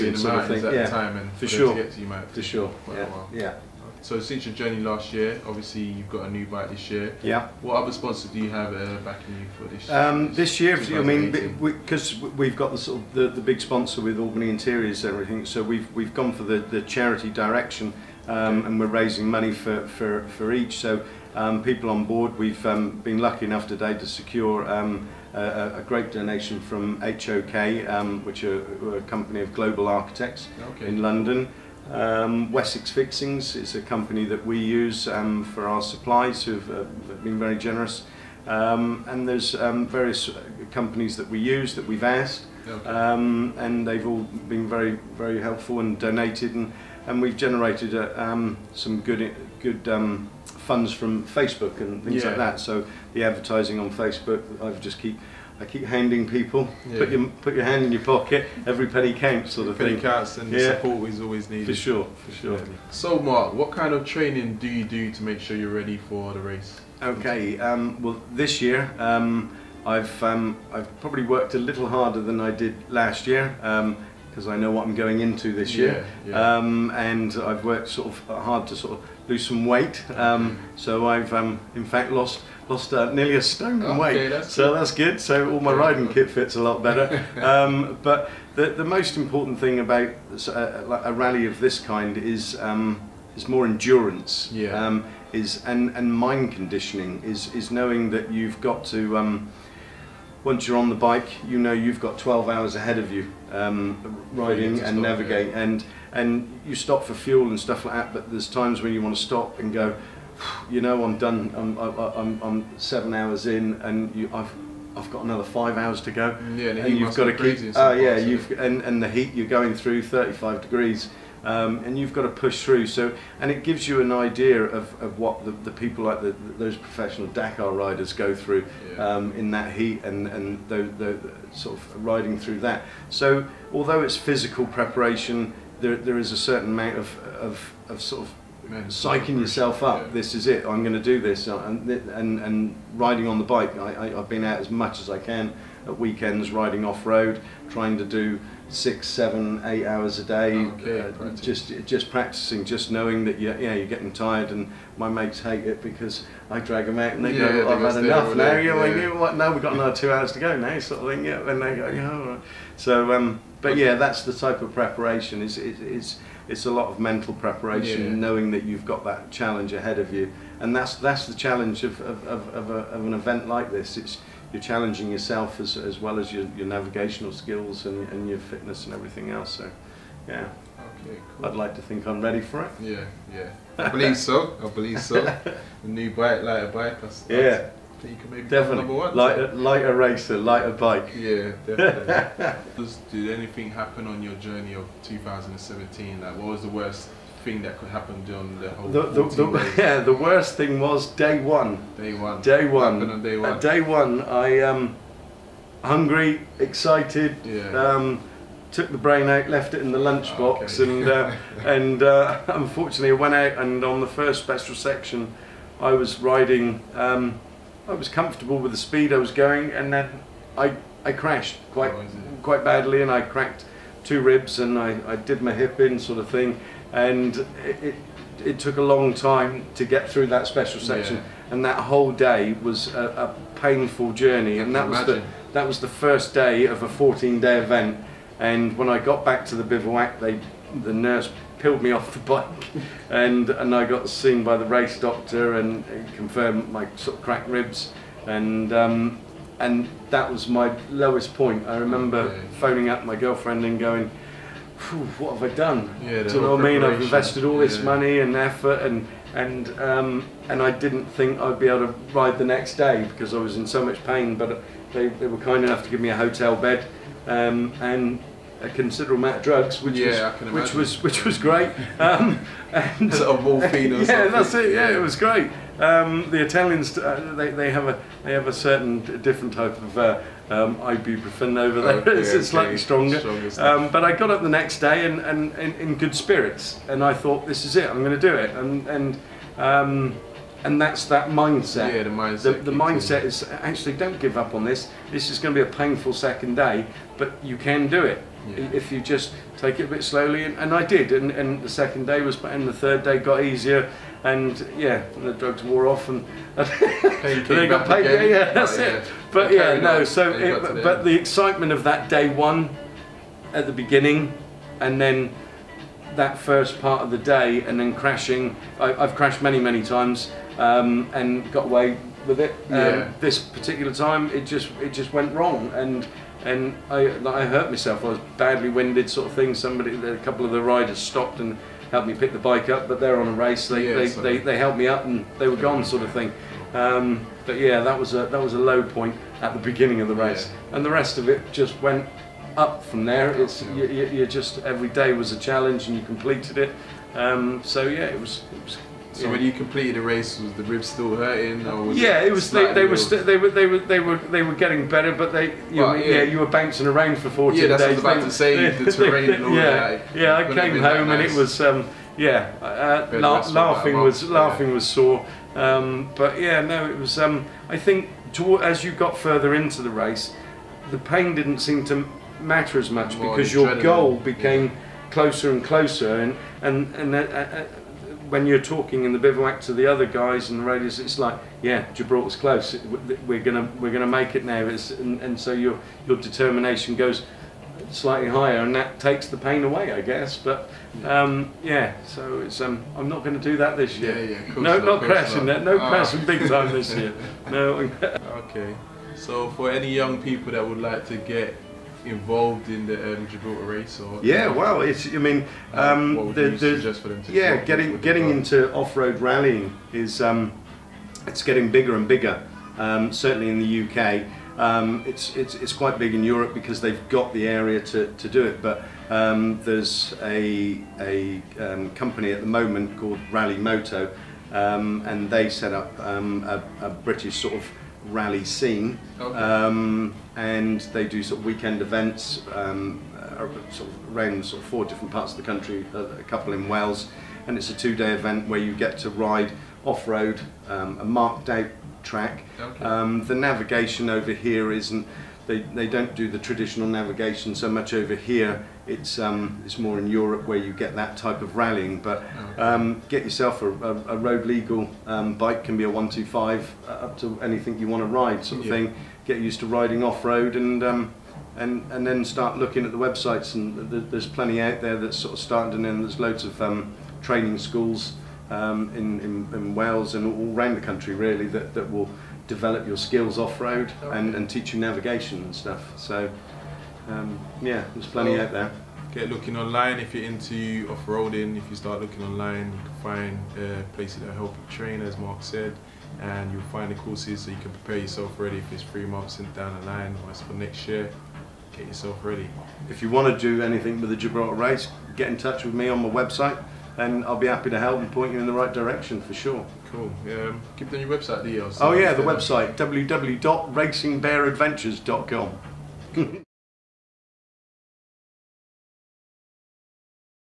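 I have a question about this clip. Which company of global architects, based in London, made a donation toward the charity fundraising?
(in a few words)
HOK.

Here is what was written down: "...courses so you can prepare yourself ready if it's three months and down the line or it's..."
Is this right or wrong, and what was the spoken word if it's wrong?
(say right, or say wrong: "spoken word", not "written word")
right.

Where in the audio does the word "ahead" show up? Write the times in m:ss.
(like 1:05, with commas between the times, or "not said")
1:42, 2:49.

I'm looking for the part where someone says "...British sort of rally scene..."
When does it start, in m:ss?
7:06.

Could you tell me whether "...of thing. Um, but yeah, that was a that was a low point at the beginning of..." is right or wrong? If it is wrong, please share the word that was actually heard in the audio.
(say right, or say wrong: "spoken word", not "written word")
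right.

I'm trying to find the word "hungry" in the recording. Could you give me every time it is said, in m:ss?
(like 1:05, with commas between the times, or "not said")
3:25.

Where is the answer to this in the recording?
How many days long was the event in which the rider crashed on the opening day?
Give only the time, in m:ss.
3:56.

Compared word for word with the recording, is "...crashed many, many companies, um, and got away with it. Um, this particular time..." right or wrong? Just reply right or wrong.
wrong.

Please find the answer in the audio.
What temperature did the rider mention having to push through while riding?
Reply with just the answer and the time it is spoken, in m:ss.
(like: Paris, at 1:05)
35 degrees, at 2:00.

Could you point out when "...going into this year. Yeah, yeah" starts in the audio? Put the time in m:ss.
1:14.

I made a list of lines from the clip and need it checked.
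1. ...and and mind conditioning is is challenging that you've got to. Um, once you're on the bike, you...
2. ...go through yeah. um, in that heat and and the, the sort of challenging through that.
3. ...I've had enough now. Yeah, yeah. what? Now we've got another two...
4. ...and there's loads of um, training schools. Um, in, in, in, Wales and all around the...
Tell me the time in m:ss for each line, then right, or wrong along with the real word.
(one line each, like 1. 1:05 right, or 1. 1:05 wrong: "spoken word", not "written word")
1. 1:35 wrong: "knowing", not "challenging"
2. 2:08 wrong: "riding", not "challenging"
3. 2:37 right
4. 7:45 right.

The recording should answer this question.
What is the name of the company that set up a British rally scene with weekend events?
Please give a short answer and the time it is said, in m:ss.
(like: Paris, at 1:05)
Rally Moto, at 7:03.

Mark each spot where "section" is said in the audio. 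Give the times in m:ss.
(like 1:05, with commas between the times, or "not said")
3:34, 3:50.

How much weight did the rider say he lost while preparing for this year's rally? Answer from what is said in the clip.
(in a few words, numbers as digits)
nearly a stone.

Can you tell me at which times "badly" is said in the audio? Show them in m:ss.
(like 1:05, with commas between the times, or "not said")
3:42, 5:28.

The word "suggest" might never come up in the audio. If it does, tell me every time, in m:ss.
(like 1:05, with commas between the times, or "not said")
6:46.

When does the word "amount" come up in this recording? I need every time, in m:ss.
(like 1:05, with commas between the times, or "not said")
2:16, 4:29.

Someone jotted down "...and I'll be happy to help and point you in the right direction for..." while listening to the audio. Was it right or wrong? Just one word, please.
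right.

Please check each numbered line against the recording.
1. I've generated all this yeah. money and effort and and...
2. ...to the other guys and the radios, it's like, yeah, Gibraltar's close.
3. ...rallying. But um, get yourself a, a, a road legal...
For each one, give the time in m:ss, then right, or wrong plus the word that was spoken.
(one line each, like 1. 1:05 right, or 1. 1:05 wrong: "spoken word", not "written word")
1. 4:16 wrong: "invested", not "generated"
2. 6:19 right
3. 7:31 right.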